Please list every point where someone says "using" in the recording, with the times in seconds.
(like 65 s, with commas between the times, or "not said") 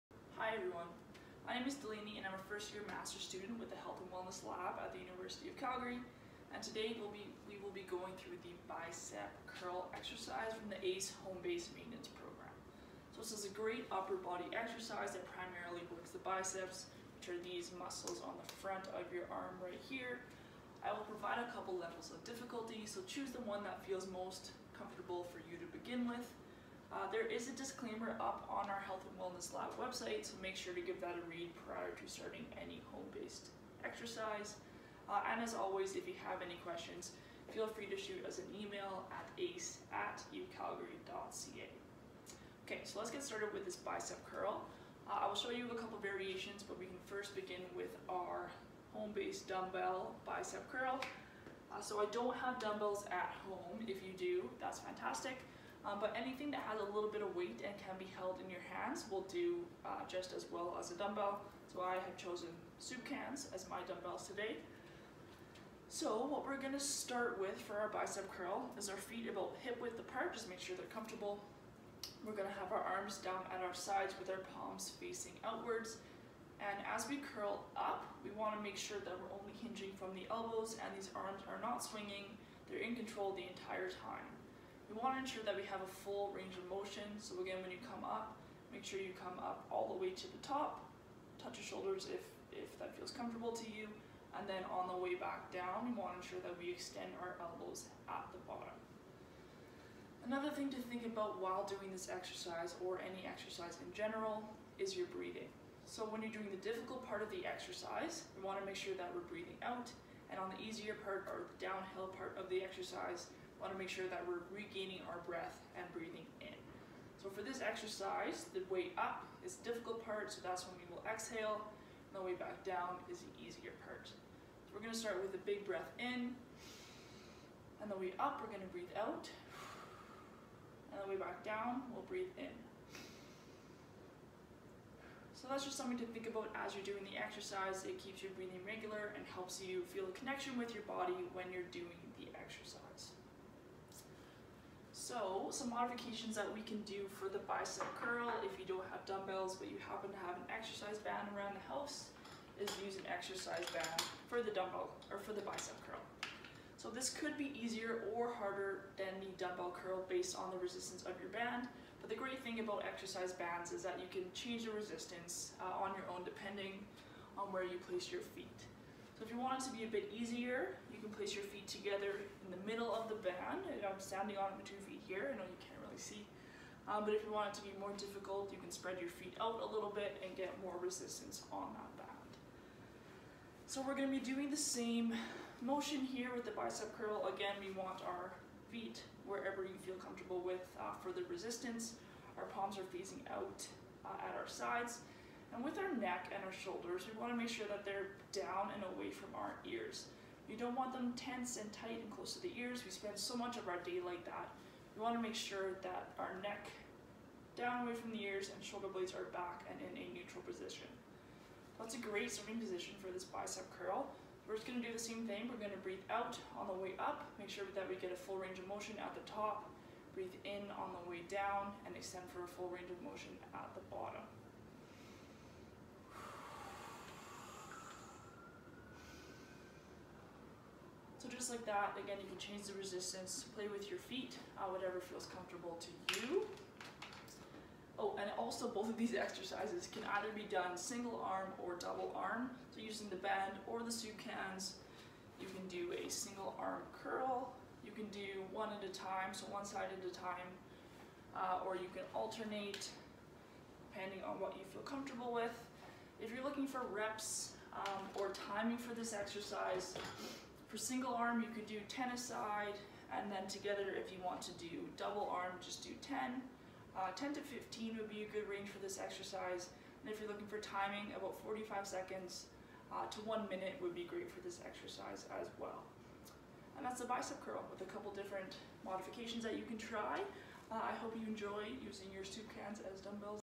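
242 s, 281 s.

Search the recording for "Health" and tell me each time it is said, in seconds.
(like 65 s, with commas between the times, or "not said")
3 s, 28 s.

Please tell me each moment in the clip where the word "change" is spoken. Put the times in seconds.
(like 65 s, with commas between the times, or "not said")
164 s, 232 s.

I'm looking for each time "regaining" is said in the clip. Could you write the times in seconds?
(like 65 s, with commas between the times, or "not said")
114 s.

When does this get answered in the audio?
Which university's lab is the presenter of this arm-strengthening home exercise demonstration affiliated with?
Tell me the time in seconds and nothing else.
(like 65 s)
5 s.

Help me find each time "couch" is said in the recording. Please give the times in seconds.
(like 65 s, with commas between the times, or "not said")
not said.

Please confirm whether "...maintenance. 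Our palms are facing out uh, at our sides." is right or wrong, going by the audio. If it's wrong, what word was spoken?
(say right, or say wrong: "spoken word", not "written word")
wrong: "resistance", not "maintenance".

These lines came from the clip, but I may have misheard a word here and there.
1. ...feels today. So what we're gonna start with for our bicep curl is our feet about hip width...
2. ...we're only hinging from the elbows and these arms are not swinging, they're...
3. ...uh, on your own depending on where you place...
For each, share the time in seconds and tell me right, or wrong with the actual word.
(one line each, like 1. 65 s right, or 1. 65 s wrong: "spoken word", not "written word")
1. 63 s wrong: "dumbbells", not "feels"
2. 79 s right
3. 165 s right.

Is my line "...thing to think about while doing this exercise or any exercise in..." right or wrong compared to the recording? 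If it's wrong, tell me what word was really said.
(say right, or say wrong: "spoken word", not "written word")
right.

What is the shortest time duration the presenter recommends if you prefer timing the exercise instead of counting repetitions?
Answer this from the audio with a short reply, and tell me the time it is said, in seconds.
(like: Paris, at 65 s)
45 seconds, at 271 s.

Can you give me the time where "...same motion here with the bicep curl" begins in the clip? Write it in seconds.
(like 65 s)
184 s.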